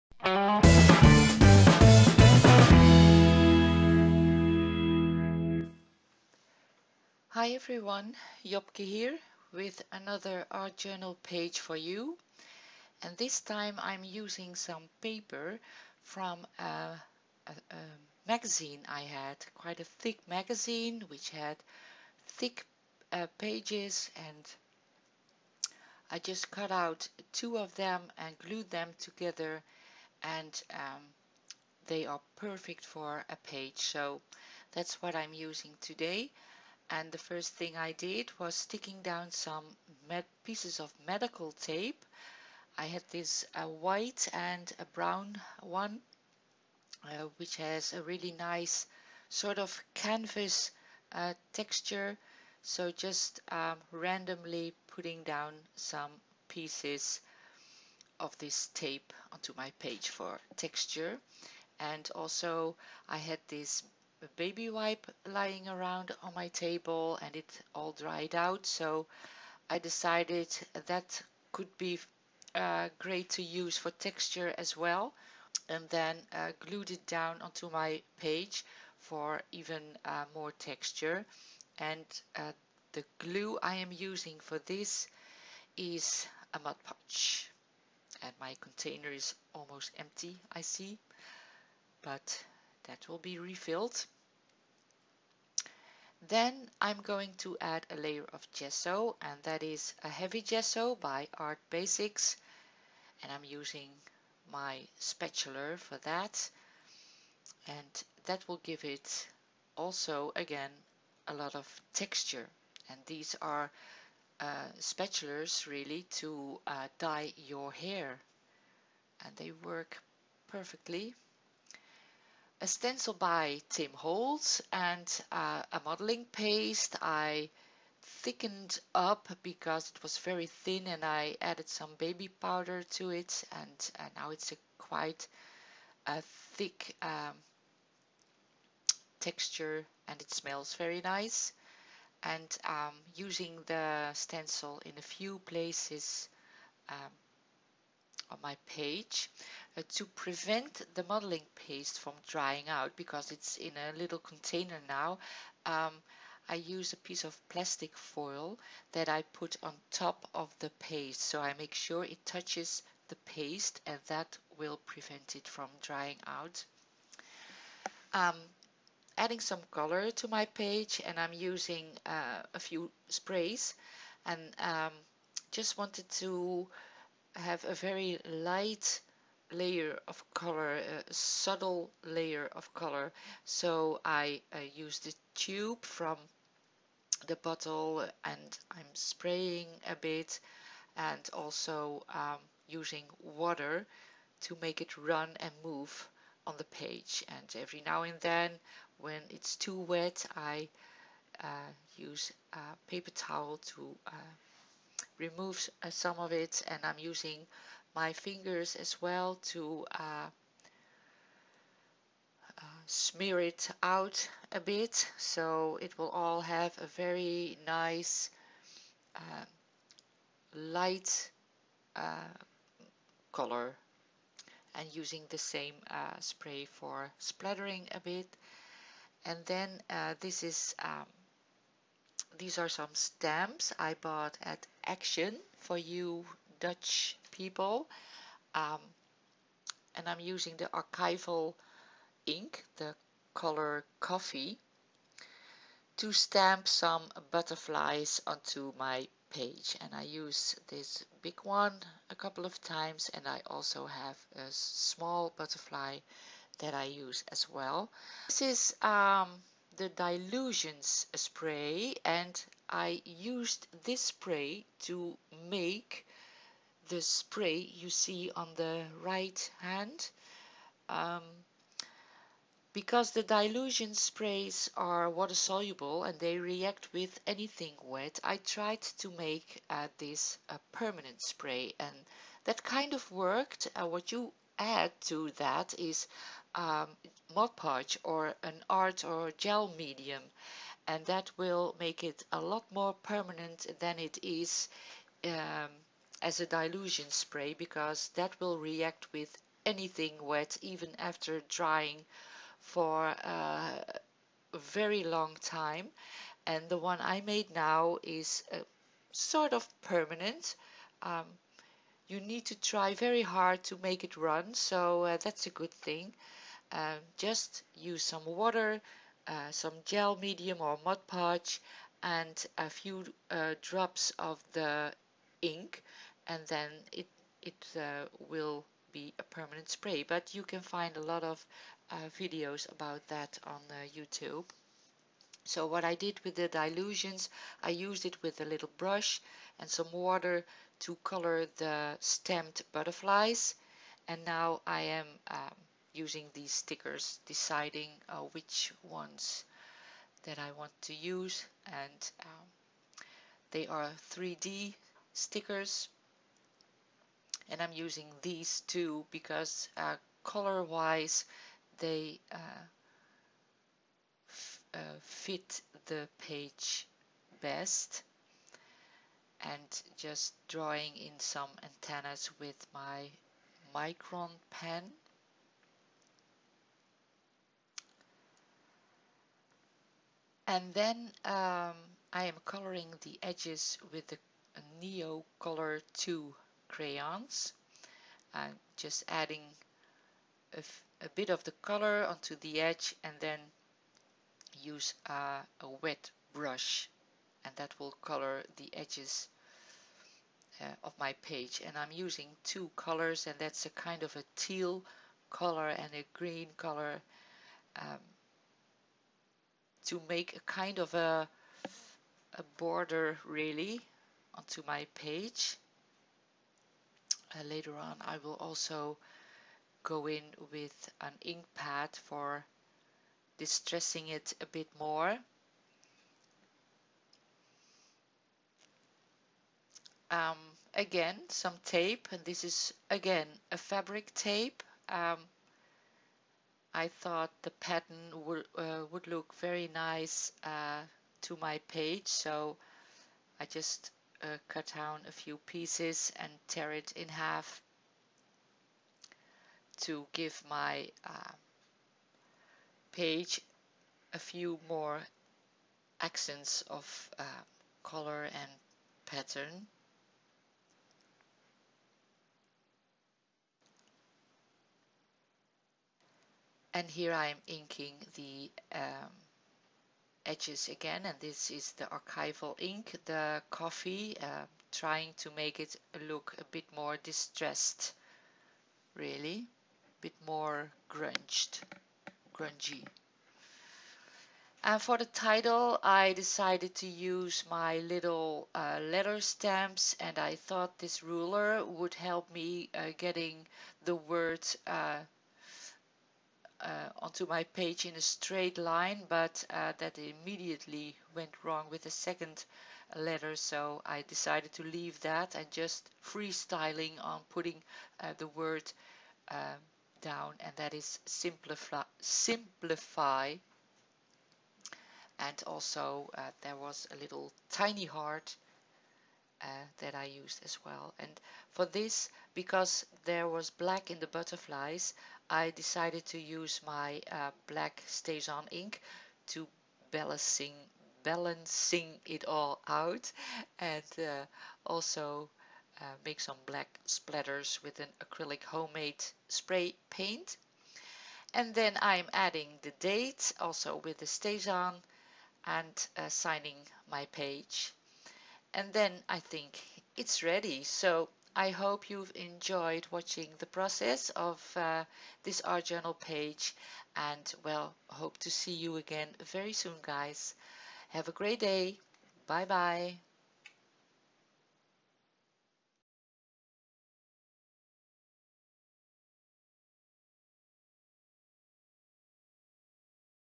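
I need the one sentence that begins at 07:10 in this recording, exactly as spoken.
Um, again, some tape, and this is again a fabric tape.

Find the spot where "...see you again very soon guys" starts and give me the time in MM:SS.
09:18.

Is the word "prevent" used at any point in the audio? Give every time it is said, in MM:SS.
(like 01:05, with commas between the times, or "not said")
02:30, 02:44.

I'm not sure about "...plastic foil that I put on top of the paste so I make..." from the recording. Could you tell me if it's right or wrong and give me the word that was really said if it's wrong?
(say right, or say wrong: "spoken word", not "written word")
right.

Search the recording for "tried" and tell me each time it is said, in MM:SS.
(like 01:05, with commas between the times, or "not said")
04:38.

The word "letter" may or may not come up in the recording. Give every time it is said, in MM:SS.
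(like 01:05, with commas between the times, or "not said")
08:08, 08:22.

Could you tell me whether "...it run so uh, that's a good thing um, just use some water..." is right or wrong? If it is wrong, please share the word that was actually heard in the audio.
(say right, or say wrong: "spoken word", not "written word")
right.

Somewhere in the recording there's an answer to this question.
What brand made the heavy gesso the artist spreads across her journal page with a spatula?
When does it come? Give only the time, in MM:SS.
01:41.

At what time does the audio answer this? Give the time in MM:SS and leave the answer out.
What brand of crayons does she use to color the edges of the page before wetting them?
06:24.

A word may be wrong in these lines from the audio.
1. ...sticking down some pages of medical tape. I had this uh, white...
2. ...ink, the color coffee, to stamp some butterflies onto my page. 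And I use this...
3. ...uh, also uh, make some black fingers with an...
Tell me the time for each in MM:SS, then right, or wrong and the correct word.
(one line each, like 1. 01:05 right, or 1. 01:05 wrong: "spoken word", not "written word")
1. 00:38 wrong: "pieces", not "pages"
2. 04:02 right
3. 08:53 wrong: "splatters", not "fingers".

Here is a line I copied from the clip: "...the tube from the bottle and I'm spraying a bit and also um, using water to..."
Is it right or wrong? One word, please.
right.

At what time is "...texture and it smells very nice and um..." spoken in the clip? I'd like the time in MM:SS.
02:19.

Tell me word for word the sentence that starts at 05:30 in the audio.
But you can find a lot of uh, videos about that on uh, YouTube.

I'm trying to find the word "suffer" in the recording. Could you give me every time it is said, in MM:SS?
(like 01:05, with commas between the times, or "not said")
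not said.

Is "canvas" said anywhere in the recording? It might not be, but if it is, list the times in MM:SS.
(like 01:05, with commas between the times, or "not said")
00:49.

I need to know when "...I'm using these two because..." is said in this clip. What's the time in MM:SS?
05:57.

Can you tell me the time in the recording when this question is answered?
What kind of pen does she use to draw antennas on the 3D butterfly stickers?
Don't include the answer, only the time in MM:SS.
06:13.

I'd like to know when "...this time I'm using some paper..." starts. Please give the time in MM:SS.
00:13.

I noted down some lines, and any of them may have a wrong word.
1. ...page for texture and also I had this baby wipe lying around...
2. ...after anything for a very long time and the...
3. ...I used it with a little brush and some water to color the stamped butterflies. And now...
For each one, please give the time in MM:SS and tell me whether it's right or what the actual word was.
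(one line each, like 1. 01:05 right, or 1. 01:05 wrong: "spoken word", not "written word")
1. 00:59 right
2. 05:00 wrong: "drying", not "anything"
3. 05:37 right.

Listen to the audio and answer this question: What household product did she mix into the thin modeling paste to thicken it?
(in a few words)
Baby powder.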